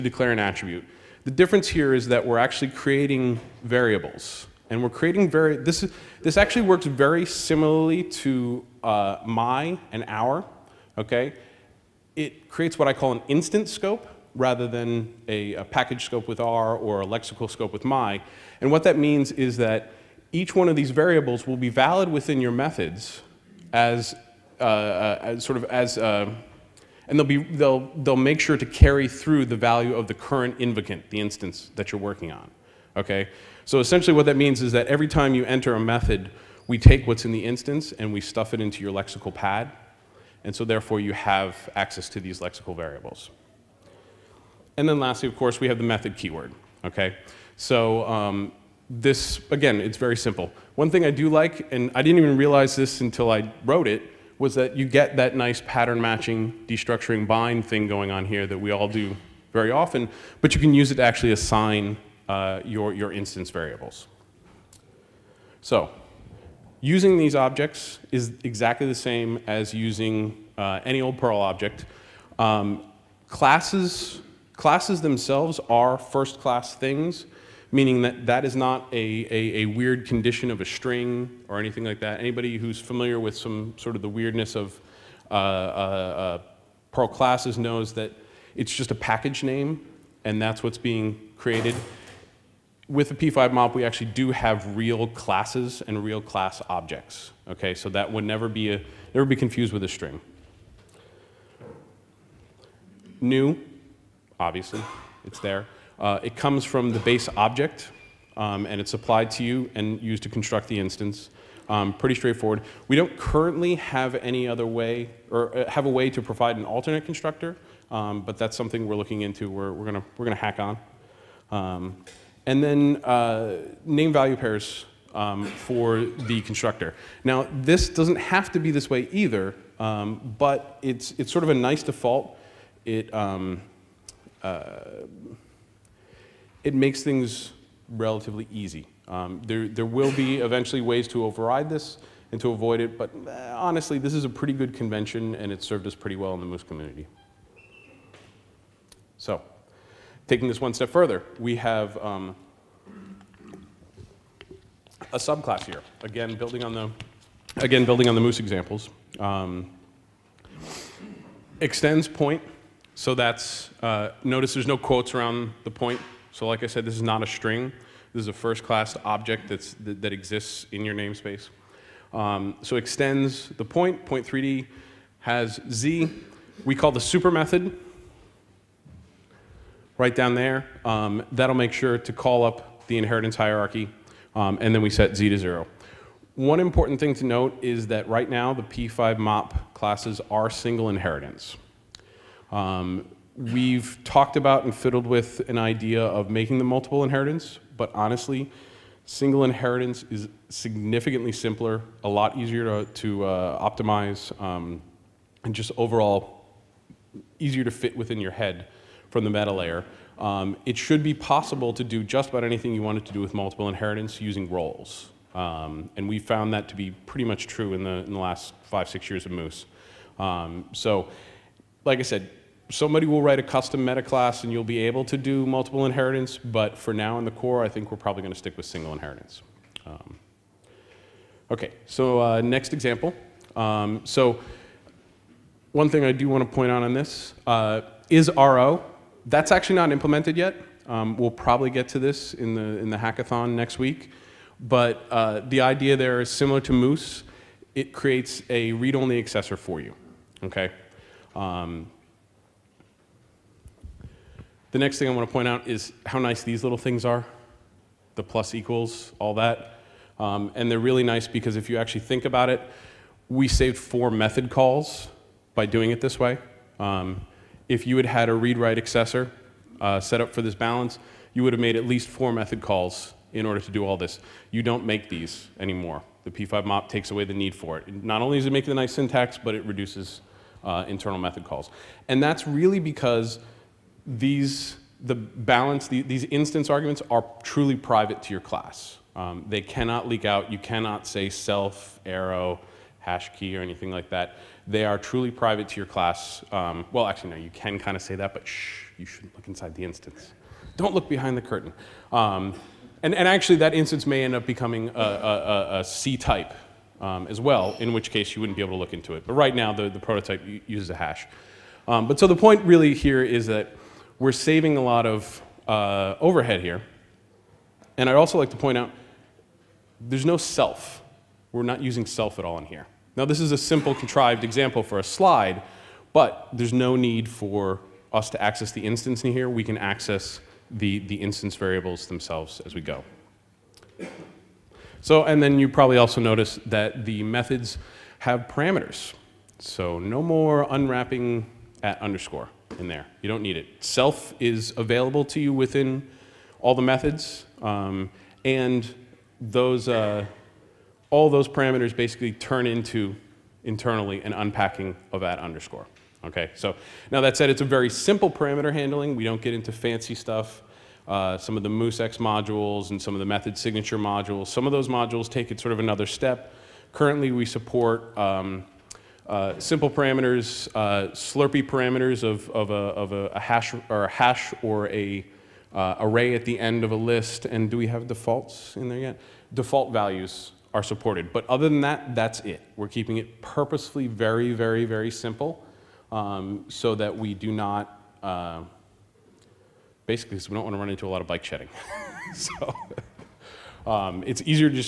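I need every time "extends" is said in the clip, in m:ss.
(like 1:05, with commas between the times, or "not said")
2:41, 2:52.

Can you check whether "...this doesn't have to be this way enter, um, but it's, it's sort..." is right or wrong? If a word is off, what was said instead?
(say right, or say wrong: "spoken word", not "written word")
wrong: "either", not "enter".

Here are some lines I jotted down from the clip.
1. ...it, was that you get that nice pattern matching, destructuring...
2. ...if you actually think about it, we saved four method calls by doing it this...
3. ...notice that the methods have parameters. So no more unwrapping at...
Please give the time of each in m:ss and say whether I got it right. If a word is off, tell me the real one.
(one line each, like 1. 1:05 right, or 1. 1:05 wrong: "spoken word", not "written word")
1. 0:53 right
2. 4:21 right
3. 5:36 right.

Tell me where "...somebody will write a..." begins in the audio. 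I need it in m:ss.
3:42.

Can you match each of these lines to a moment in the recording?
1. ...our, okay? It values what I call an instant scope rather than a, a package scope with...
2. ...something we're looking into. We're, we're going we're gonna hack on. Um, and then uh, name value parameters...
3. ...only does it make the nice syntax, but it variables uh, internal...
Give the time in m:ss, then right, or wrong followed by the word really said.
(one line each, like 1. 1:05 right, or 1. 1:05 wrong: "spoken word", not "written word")
1. 0:10 wrong: "creates", not "values"
2. 1:58 wrong: "pairs", not "parameters"
3. 4:38 wrong: "reduces", not "variables".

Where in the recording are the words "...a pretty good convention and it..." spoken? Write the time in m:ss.
2:24.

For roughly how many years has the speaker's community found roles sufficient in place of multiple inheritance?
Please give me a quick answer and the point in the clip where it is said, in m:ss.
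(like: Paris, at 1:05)
5 or 6 years, at 3:38.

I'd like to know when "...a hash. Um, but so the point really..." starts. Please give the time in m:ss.
5:10.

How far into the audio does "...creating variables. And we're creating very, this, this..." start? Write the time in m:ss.
0:02.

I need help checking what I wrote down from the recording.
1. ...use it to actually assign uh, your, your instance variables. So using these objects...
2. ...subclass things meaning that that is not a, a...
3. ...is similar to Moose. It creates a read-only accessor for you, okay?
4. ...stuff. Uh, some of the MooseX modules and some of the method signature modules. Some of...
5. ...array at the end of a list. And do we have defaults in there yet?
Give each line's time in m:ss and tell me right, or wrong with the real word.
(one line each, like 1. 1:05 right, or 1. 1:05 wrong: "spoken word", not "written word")
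1. 1:00 right
2. 1:16 wrong: "class", not "subclass"
3. 4:06 right
4. 6:00 right
5. 6:15 right.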